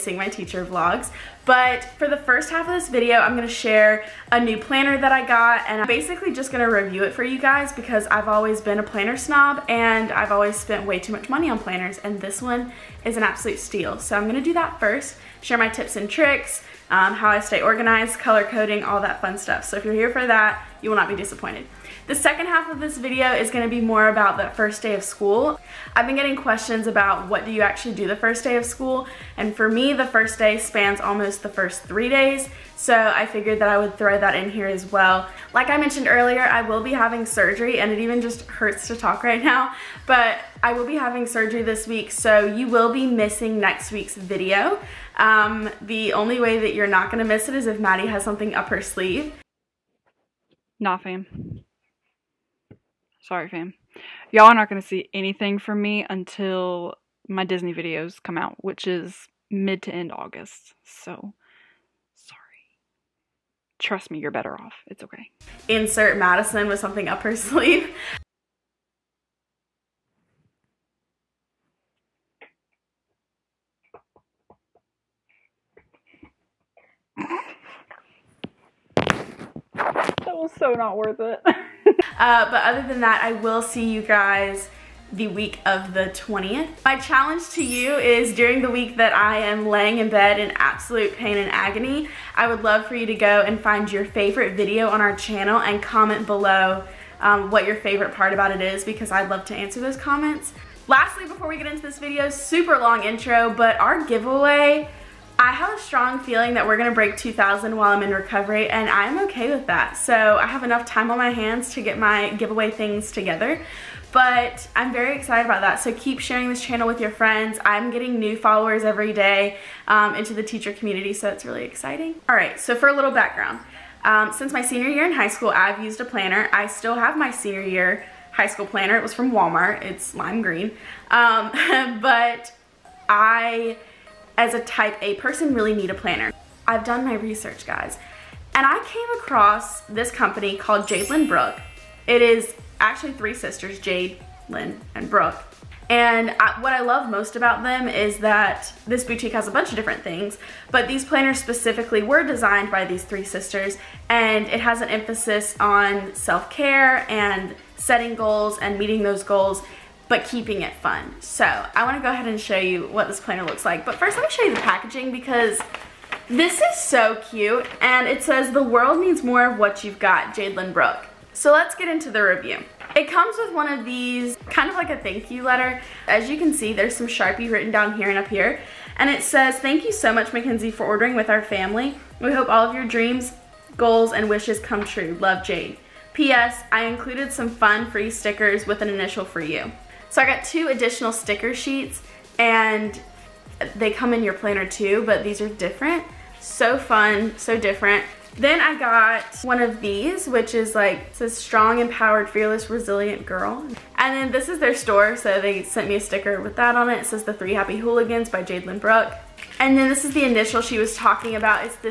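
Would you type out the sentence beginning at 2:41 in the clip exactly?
So I wanna go ahead and show you what this planner looks like.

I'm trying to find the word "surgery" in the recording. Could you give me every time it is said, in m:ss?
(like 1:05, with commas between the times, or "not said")
0:37, 0:41.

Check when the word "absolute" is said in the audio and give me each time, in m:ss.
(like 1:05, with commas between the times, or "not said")
0:13, 1:30.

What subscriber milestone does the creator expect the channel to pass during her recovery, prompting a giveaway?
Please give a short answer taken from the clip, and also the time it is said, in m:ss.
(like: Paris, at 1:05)
2,000, at 1:47.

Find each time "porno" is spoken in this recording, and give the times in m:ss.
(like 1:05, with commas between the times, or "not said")
not said.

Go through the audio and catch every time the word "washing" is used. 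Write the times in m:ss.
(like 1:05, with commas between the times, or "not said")
not said.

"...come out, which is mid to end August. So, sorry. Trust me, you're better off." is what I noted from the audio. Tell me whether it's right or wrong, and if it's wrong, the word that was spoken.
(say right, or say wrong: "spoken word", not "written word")
right.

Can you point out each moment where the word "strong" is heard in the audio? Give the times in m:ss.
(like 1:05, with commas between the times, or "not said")
1:45, 3:21.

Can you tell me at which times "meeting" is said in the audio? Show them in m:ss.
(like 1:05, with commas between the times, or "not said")
2:38.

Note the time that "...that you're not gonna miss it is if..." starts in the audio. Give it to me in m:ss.
0:46.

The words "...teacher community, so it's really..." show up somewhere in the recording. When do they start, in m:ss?
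2:00.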